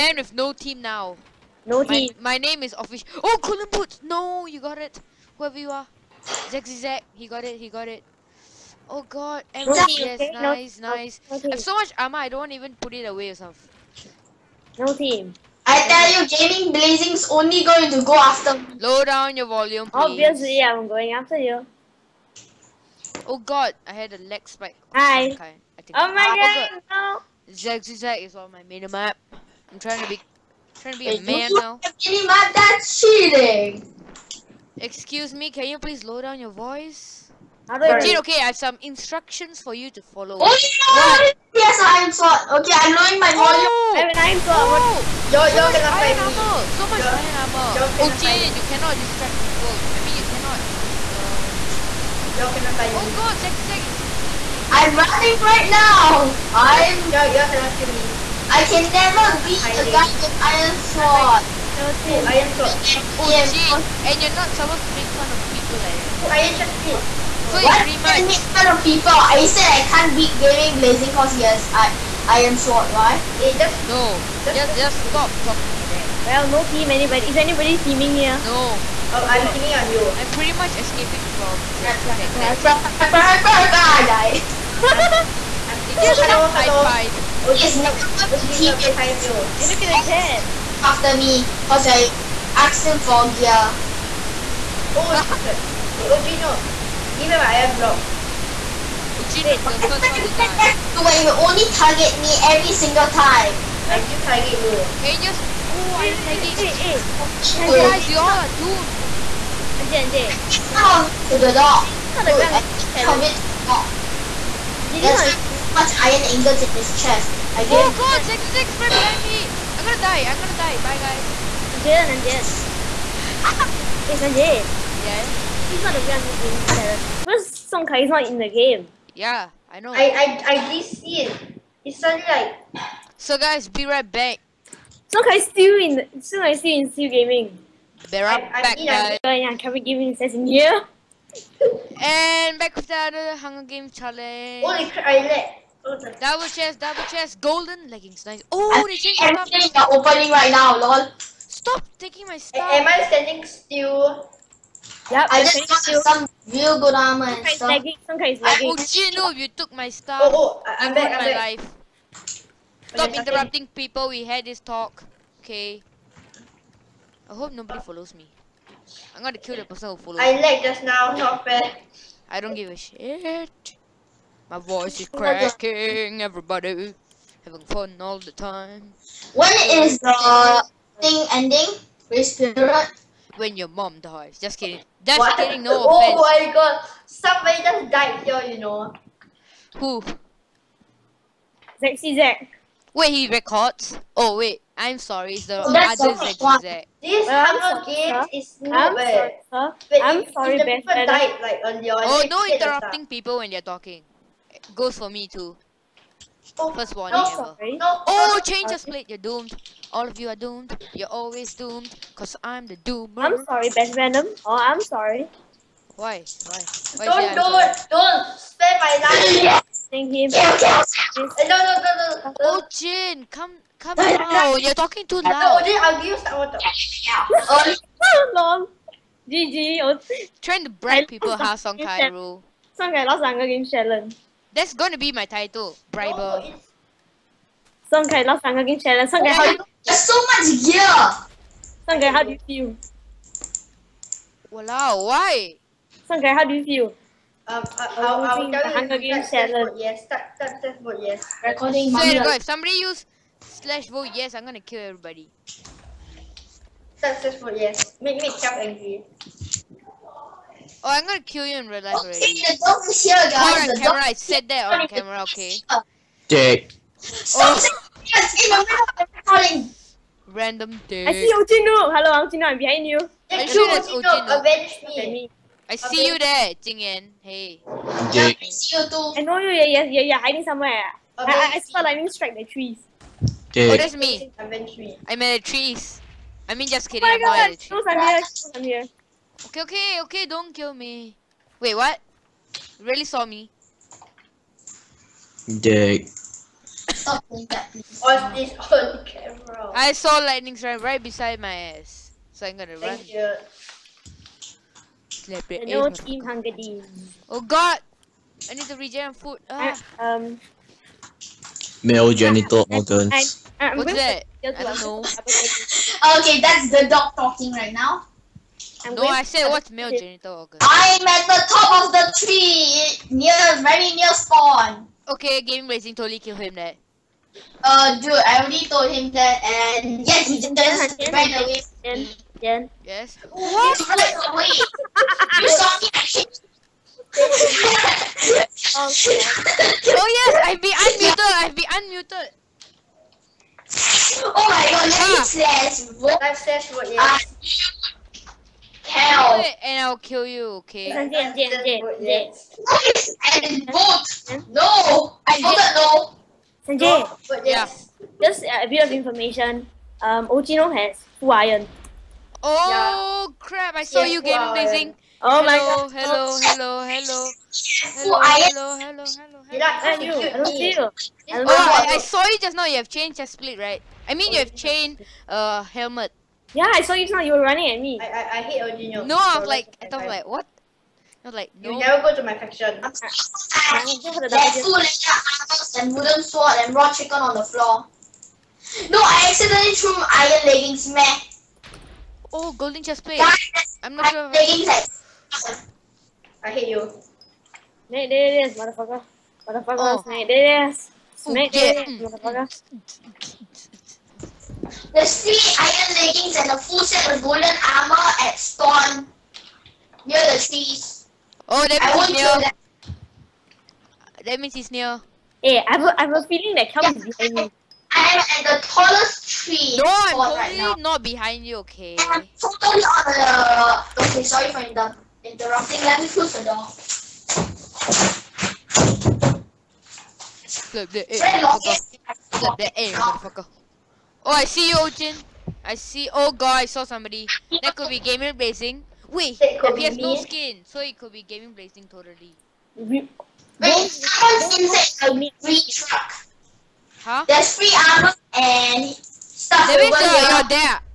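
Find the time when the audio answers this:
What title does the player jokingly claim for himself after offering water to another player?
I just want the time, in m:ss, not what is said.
3:55.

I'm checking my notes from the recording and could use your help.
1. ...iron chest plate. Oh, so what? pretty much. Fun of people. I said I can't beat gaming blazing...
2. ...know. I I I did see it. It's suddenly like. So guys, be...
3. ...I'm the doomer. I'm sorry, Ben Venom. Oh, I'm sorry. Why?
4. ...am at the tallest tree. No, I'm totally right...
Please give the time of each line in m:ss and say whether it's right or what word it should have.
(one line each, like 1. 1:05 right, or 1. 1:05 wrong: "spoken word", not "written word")
1. 1:06 right
2. 2:09 right
3. 3:32 right
4. 6:58 right.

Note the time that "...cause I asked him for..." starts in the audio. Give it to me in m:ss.
1:31.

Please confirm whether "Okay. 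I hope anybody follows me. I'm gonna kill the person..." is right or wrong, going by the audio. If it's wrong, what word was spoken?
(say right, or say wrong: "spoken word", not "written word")
wrong: "nobody", not "anybody".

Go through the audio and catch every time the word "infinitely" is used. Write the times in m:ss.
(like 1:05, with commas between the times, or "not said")
not said.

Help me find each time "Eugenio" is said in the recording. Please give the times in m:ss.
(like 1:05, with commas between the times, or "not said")
6:18.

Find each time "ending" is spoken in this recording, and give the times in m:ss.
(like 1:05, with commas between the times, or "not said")
3:01.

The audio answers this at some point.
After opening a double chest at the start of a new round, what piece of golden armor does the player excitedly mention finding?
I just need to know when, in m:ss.
2:27.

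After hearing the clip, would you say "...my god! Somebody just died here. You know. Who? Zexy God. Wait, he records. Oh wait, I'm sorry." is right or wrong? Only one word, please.
wrong.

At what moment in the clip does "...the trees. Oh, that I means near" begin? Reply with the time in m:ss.
6:50.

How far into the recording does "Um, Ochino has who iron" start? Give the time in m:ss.
6:00.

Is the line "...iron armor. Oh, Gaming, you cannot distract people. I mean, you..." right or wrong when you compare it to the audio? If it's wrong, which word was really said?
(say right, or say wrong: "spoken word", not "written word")
wrong: "Jane", not "Gaming".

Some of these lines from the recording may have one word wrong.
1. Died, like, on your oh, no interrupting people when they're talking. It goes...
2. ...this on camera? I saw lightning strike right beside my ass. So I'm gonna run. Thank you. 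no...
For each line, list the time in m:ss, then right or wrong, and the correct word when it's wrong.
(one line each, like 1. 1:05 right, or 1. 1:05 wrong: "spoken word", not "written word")
1. 3:21 right
2. 4:58 right.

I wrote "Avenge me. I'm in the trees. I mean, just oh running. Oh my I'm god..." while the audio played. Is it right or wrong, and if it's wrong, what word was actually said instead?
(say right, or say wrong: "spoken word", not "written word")
wrong: "kidding", not "running".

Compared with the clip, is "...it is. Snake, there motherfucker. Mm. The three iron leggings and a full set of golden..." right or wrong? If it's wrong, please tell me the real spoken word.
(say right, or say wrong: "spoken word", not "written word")
right.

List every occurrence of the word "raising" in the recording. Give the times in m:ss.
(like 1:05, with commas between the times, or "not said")
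5:25.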